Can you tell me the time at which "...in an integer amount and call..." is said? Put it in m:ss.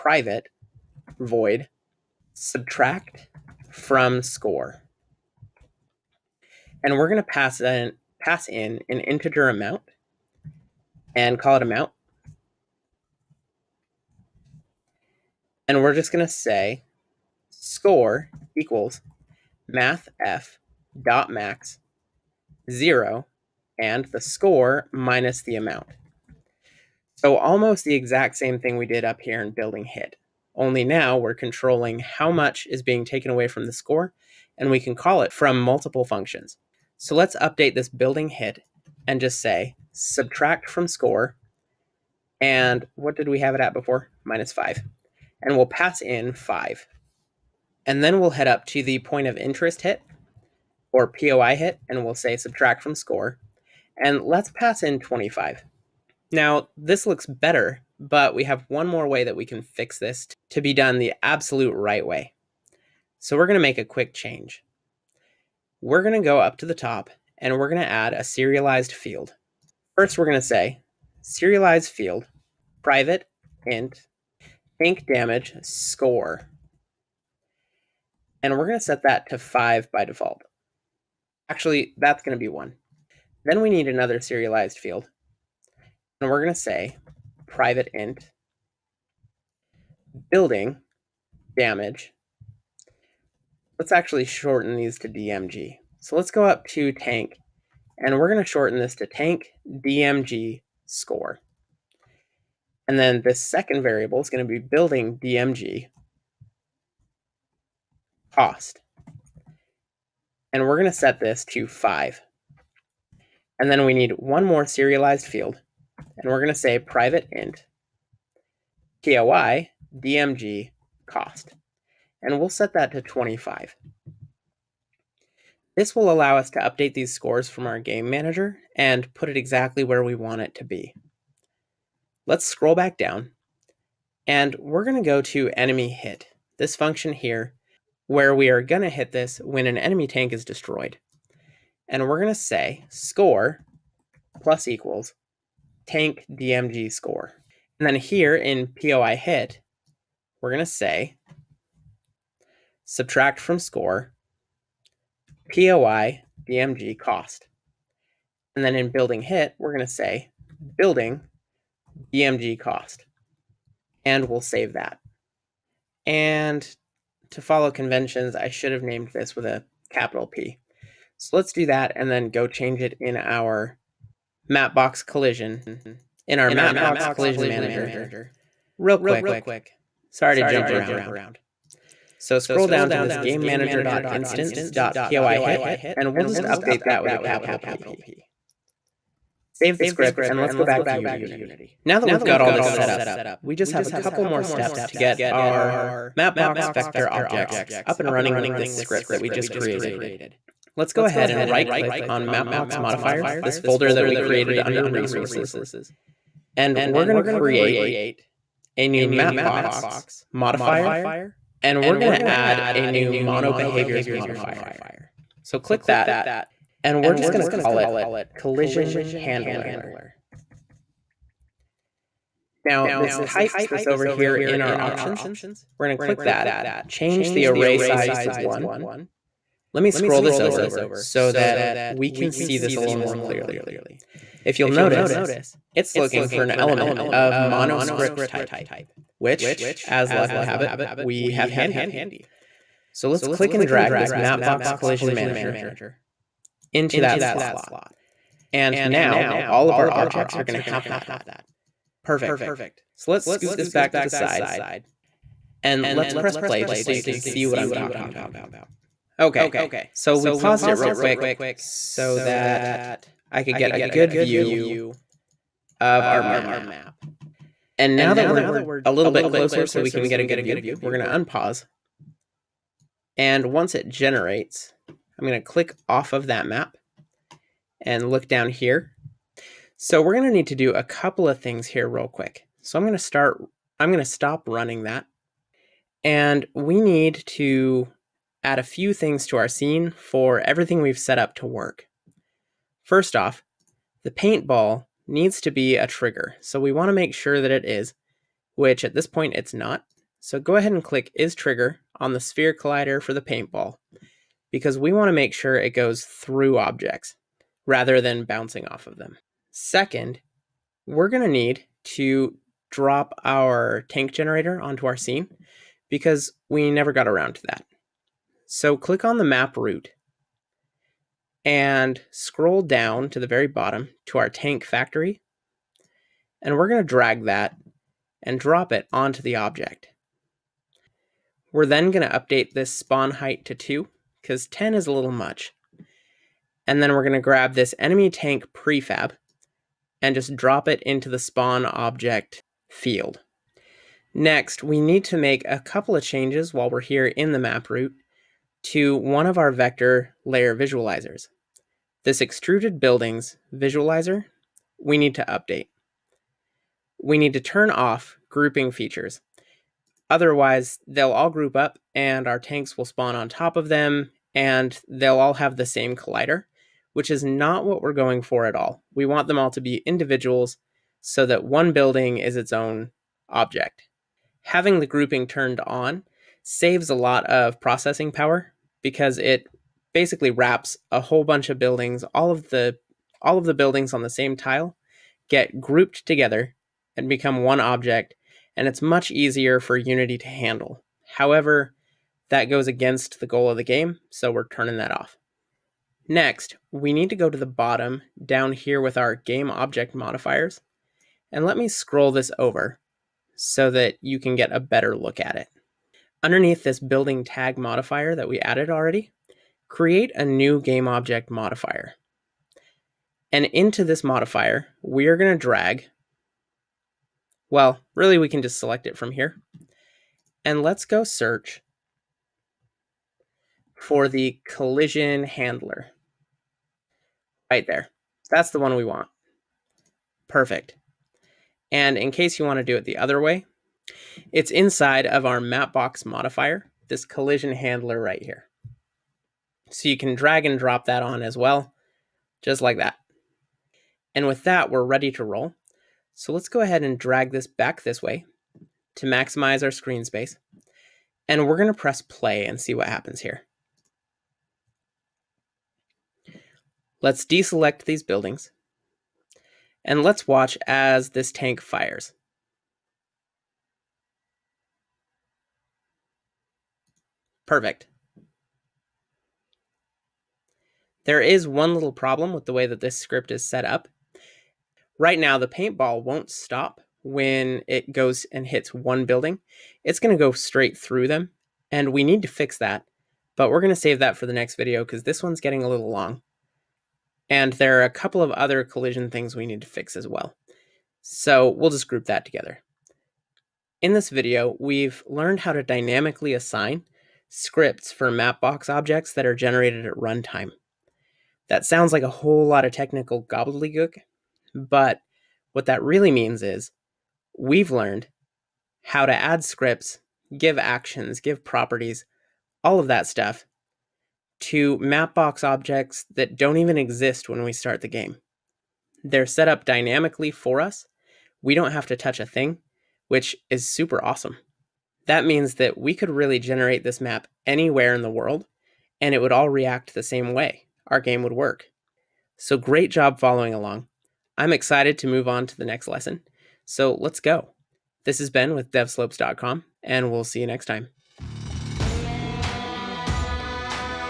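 0:08.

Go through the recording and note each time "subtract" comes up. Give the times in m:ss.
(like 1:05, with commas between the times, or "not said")
0:02, 0:39, 0:52, 2:32.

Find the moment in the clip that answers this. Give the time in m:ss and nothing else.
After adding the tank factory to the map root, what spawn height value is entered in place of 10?
5:33.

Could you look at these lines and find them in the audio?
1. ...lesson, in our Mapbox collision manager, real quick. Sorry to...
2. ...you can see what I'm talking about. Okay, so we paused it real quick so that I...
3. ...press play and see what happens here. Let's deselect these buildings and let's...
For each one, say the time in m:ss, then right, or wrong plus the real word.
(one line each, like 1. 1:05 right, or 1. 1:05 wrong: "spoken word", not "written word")
1. 2:55 wrong: "collision", not "lesson"
2. 4:16 right
3. 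7:31 right.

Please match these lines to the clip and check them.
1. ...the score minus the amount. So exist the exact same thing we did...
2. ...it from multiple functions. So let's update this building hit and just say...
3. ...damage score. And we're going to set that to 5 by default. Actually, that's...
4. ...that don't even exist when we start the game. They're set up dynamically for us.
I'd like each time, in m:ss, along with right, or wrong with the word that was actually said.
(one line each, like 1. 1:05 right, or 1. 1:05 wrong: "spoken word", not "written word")
1. 0:24 wrong: "almost", not "exist"
2. 0:35 right
3. 1:15 right
4. 8:36 right.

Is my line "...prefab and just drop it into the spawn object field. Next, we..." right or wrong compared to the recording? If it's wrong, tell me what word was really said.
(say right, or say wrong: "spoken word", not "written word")
right.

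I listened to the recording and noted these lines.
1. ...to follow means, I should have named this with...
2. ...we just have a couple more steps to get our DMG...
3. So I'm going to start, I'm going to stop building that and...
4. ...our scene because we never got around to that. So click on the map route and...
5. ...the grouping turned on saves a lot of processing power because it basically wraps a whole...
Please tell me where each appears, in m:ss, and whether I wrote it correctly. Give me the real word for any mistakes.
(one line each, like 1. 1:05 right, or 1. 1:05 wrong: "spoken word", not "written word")
1. 2:47 wrong: "conventions", not "means"
2. 3:13 wrong: "Mapbox", not "DMG"
3. 4:42 wrong: "running", not "building"
4. 5:14 right
5. 6:14 right.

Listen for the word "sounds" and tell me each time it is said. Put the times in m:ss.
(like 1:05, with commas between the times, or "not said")
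8:21.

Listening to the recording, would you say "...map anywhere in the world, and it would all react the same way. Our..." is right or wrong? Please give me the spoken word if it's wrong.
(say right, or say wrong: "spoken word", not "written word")
right.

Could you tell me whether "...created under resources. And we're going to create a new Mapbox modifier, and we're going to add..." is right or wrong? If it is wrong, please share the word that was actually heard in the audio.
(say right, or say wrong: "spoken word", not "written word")
right.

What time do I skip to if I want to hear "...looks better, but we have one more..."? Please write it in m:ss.
0:57.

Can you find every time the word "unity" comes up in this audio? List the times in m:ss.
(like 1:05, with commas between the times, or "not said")
3:10, 6:29.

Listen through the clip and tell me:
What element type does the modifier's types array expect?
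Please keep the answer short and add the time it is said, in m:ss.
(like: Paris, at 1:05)
monoscript, at 3:57.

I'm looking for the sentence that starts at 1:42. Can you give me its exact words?
And then this second variable is going to be building DMG cost and we're going to set this to 5.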